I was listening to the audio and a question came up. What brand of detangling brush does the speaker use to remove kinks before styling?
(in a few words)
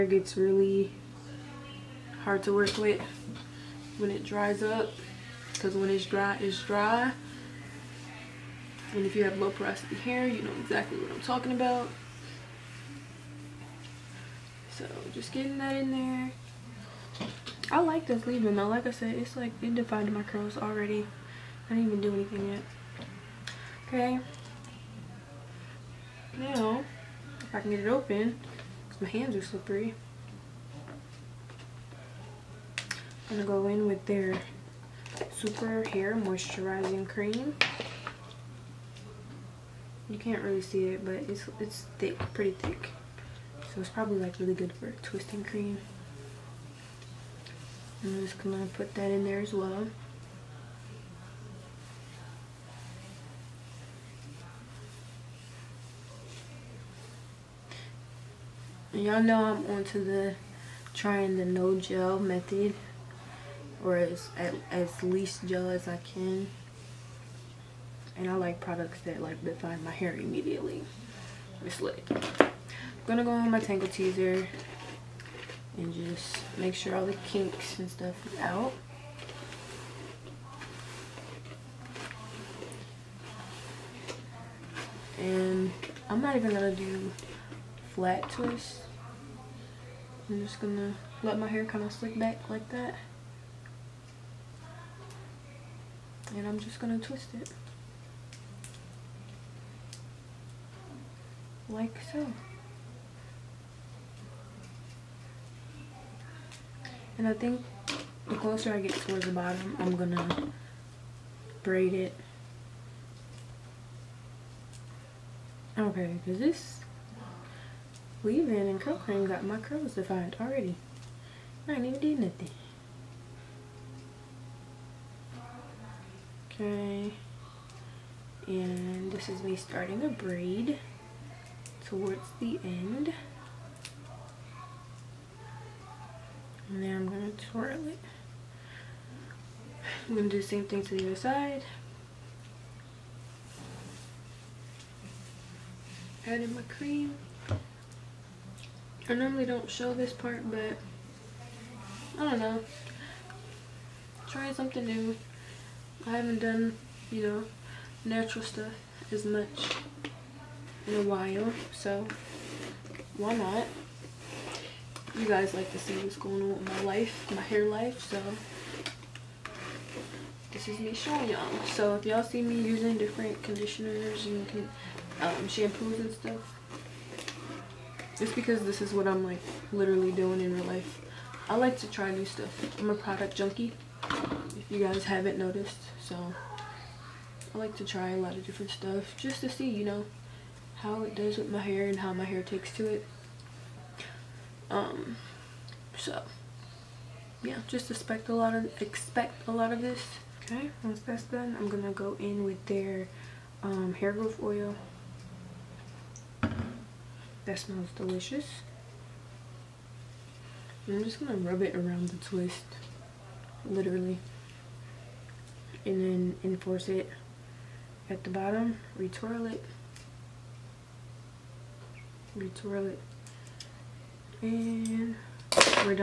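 Tangle Teezer.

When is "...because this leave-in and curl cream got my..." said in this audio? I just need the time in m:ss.
1:56.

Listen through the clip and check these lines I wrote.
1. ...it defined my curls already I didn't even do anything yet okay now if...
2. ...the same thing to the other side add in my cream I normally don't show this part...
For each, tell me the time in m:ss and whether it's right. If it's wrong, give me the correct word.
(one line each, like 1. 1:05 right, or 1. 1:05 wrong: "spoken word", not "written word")
1. 0:19 right
2. 2:20 right.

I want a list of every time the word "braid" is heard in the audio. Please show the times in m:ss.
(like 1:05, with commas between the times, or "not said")
1:51, 2:10.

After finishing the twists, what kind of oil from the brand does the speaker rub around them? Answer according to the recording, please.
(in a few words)
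Hair growth oil.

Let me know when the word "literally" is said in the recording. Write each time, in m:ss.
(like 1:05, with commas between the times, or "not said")
2:59, 3:33.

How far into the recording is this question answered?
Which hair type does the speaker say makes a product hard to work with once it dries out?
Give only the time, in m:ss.
0:09.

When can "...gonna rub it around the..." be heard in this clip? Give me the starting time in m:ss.
3:31.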